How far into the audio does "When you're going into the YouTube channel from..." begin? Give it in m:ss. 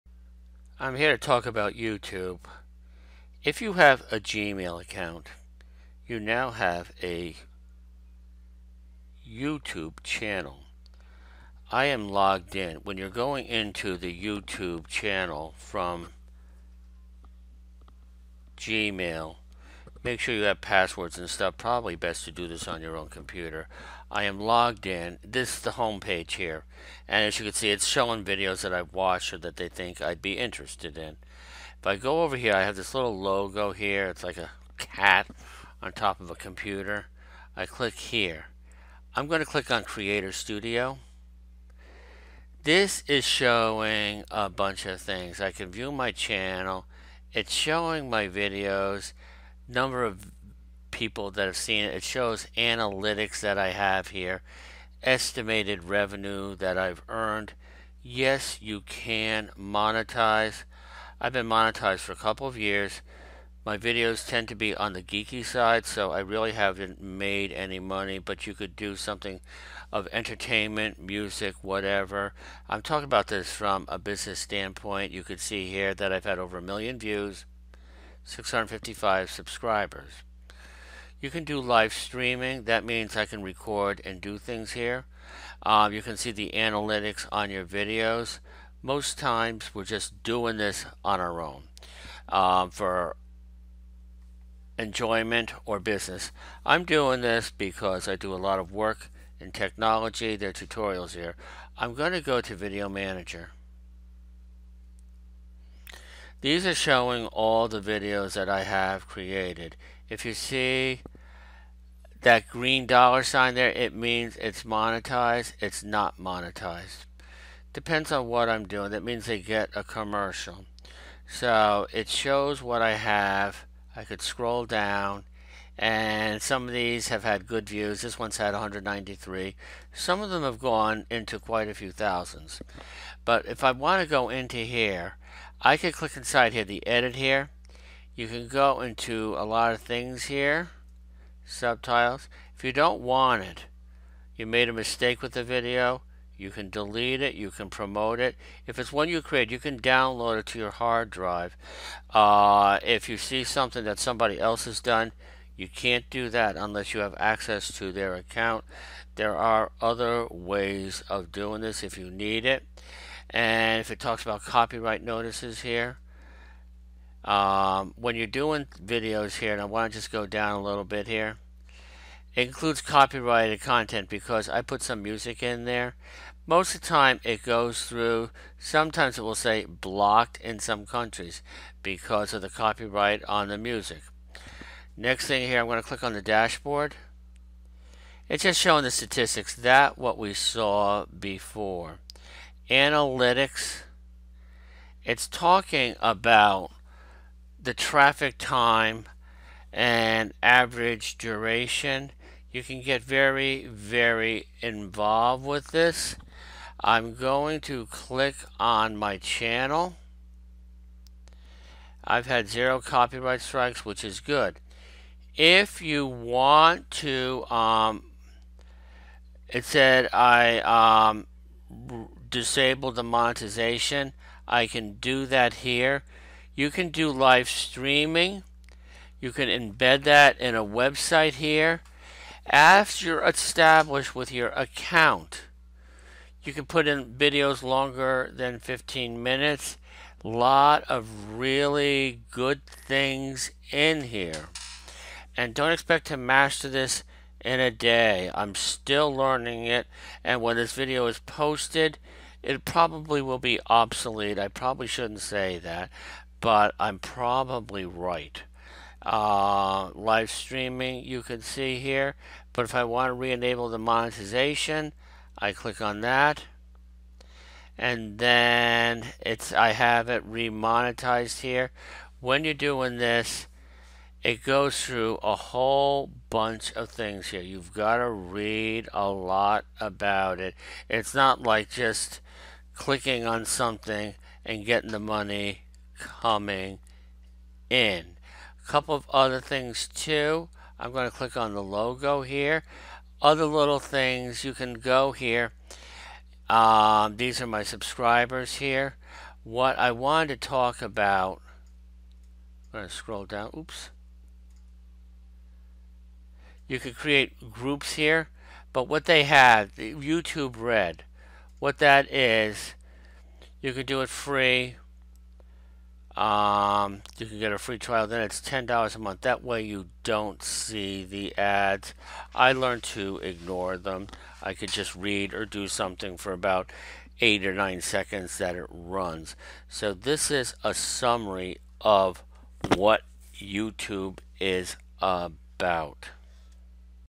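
0:12.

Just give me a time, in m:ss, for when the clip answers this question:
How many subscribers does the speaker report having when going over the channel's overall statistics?
1:18.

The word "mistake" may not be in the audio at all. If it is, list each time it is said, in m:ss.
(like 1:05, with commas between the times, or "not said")
2:24.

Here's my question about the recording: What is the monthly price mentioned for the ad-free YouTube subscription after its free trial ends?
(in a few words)
$10.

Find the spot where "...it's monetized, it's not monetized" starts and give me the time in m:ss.
1:54.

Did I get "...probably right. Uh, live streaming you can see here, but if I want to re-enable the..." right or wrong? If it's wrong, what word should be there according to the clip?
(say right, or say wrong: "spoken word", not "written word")
right.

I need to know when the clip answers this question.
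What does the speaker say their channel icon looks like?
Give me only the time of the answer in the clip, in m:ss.
0:34.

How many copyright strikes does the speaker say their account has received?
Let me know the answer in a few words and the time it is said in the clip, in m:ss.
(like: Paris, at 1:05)
0, at 3:32.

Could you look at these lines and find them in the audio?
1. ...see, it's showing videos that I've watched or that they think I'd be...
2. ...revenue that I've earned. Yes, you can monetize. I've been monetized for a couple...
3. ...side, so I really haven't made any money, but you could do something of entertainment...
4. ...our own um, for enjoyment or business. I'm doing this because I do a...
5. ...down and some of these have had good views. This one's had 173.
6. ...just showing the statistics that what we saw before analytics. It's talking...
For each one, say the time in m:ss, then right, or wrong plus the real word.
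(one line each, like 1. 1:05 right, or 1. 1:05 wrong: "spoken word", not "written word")
1. 0:27 right
2. 0:55 right
3. 1:05 right
4. 1:31 right
5. 2:04 wrong: "193", not "173"
6. 3:08 right.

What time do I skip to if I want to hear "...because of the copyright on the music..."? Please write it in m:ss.
3:01.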